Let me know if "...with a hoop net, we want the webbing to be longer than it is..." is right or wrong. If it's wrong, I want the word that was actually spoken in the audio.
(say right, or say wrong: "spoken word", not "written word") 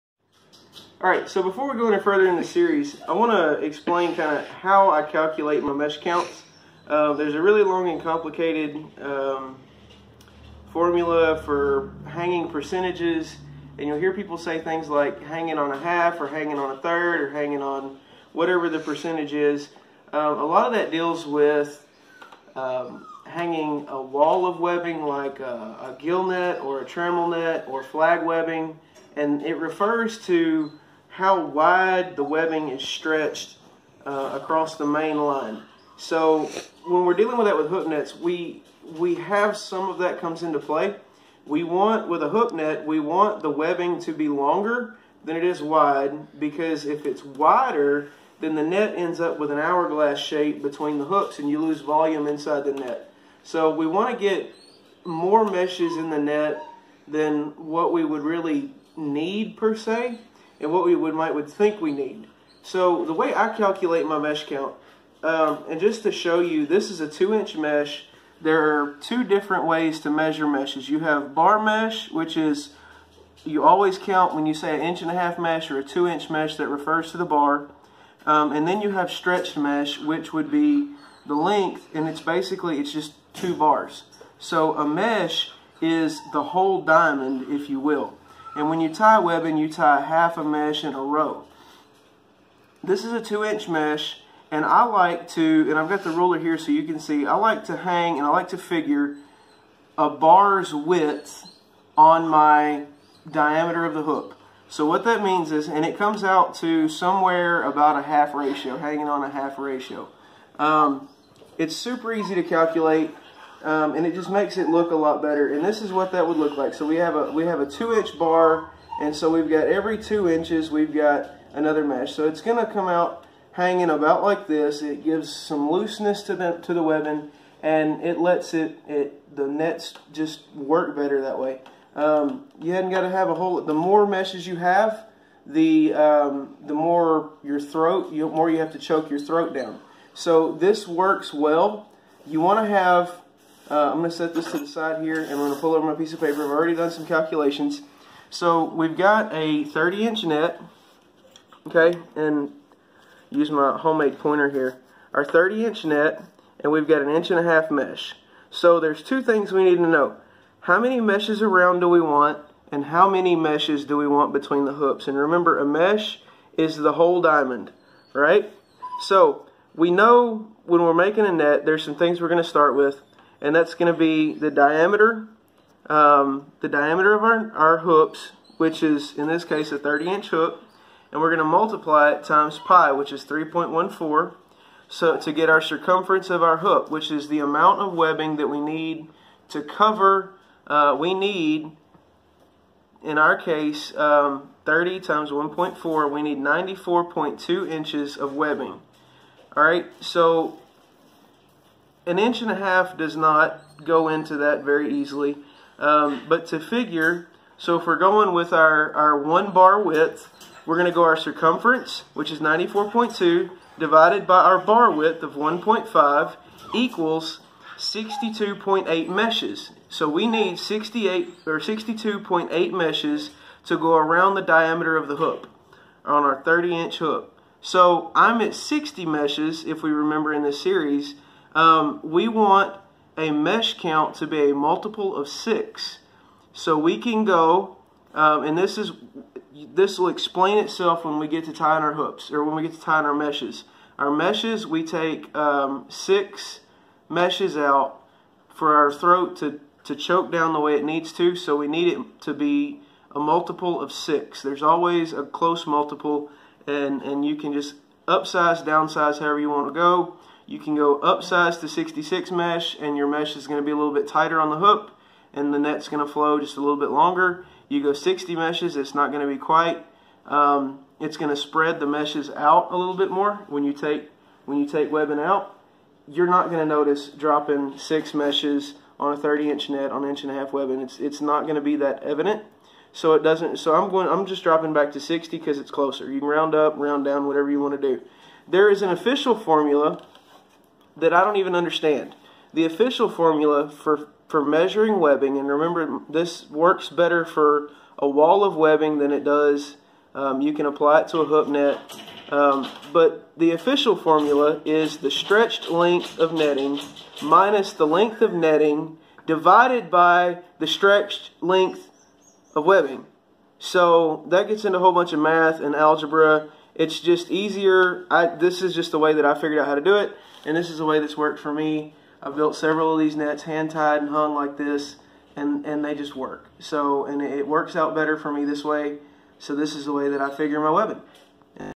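right.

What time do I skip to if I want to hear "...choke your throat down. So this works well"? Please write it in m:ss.
2:18.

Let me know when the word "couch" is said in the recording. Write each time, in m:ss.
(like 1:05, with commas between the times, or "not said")
not said.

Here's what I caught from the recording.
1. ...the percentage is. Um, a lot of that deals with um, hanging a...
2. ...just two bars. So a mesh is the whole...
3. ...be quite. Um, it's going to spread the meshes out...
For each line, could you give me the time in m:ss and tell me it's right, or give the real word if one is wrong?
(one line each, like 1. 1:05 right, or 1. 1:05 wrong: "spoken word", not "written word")
1. 0:18 right
2. 1:22 right
3. 4:29 right.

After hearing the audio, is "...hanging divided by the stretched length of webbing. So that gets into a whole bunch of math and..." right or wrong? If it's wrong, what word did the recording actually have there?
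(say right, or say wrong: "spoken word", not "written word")
wrong: "netting", not "hanging".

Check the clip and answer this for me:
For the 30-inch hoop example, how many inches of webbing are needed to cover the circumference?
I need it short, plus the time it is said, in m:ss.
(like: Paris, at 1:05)
94.2 inches, at 3:16.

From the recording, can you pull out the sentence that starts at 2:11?
Um, you hadn't got to have a whole.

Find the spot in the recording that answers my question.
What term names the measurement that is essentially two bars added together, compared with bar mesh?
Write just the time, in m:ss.
1:19.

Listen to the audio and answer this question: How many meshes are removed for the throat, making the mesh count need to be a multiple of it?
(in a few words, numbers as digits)
6.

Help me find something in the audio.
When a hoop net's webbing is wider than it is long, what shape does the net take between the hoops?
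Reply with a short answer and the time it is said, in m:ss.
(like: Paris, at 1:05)
hourglass, at 0:49.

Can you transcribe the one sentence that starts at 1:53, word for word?
Um, and it just makes it look a lot better.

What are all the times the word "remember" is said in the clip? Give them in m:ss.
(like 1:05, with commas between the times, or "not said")
2:45, 3:49, 4:55.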